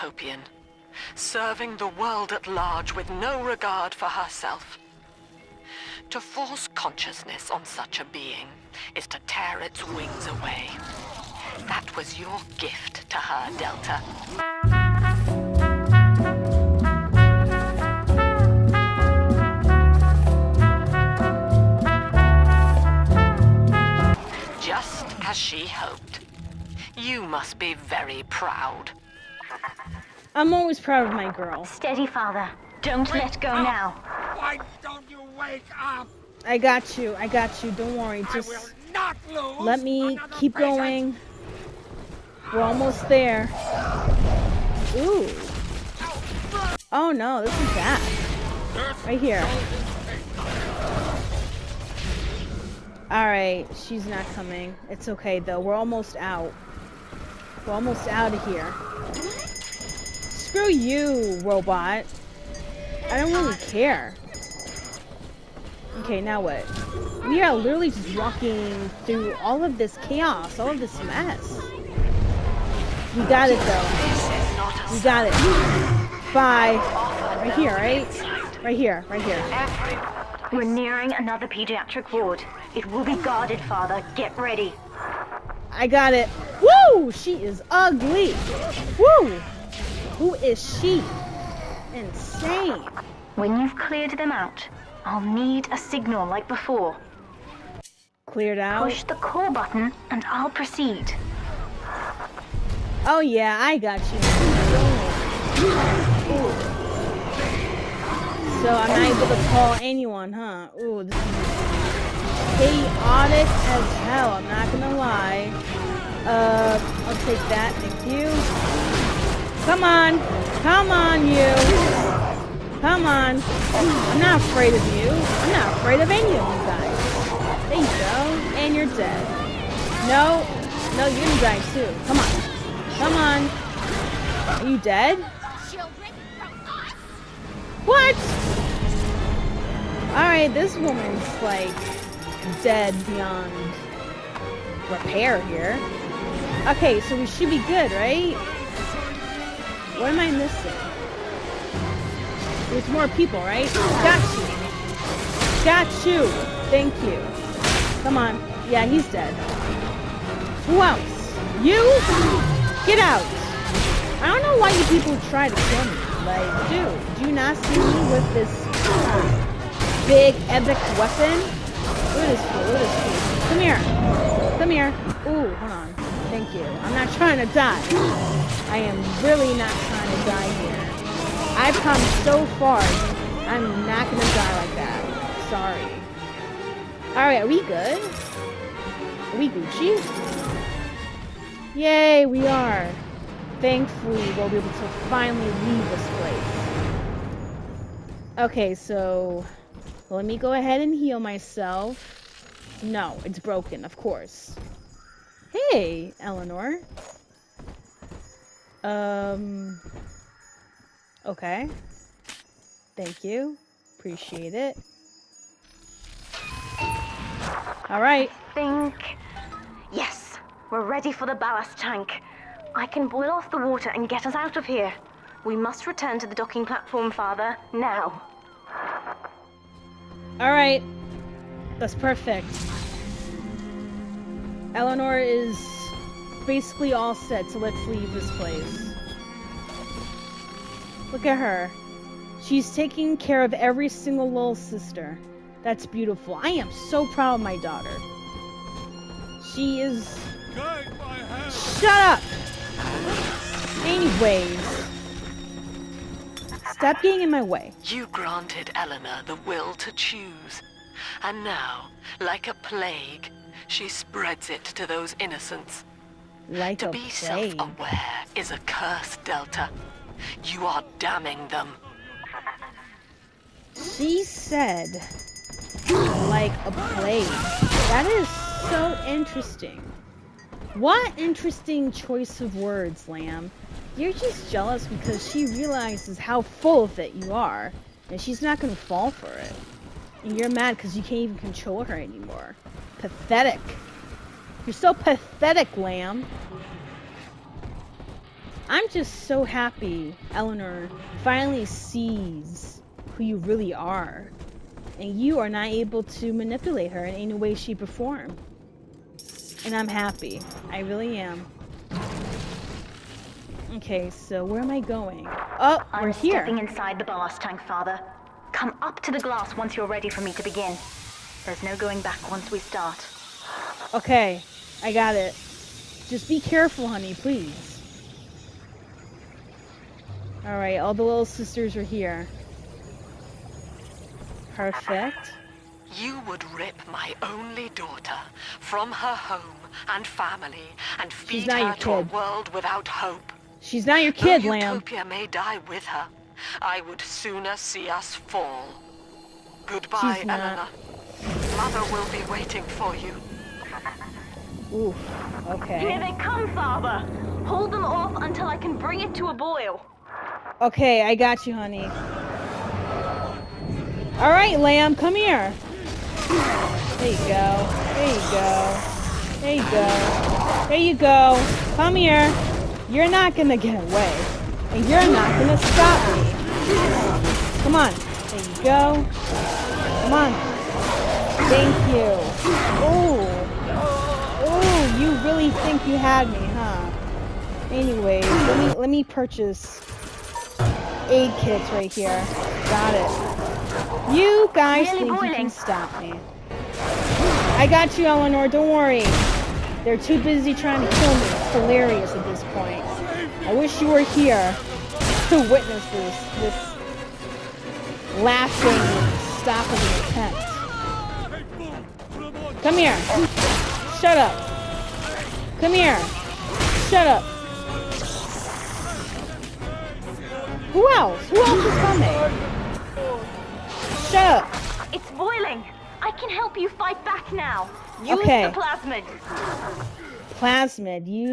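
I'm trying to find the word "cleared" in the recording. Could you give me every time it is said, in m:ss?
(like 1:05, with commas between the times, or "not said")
1:33, 1:38.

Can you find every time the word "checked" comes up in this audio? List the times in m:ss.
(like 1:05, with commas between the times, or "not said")
not said.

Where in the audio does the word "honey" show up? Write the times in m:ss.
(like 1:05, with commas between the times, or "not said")
5:26, 6:01.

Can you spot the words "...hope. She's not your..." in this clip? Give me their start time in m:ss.
5:42.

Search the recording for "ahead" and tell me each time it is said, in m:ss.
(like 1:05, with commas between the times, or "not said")
3:20.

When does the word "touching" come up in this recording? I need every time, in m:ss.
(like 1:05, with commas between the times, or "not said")
not said.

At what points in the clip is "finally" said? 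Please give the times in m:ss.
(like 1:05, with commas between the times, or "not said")
3:15, 5:01.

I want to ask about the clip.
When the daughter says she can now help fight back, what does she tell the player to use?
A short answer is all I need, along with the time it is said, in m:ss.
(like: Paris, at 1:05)
The plasmid, at 7:08.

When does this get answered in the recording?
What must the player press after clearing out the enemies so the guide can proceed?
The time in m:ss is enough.
1:39.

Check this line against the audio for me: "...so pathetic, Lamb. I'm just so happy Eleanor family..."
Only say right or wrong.
wrong.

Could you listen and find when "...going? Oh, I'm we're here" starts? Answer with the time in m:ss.
5:14.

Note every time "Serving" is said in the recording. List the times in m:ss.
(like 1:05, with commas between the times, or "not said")
0:01.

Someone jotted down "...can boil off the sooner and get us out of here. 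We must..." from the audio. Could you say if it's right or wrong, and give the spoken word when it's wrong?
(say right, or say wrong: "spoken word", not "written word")
wrong: "water", not "sooner".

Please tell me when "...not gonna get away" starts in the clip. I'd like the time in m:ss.
6:13.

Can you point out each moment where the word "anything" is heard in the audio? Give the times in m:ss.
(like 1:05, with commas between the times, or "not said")
not said.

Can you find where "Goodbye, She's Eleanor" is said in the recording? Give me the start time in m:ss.
5:49.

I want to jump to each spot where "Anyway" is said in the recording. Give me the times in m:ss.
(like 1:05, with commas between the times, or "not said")
6:27.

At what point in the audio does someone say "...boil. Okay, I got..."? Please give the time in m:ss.
5:59.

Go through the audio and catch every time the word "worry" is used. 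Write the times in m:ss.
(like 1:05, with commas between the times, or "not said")
0:37, 6:38.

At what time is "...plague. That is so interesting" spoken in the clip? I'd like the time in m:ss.
4:36.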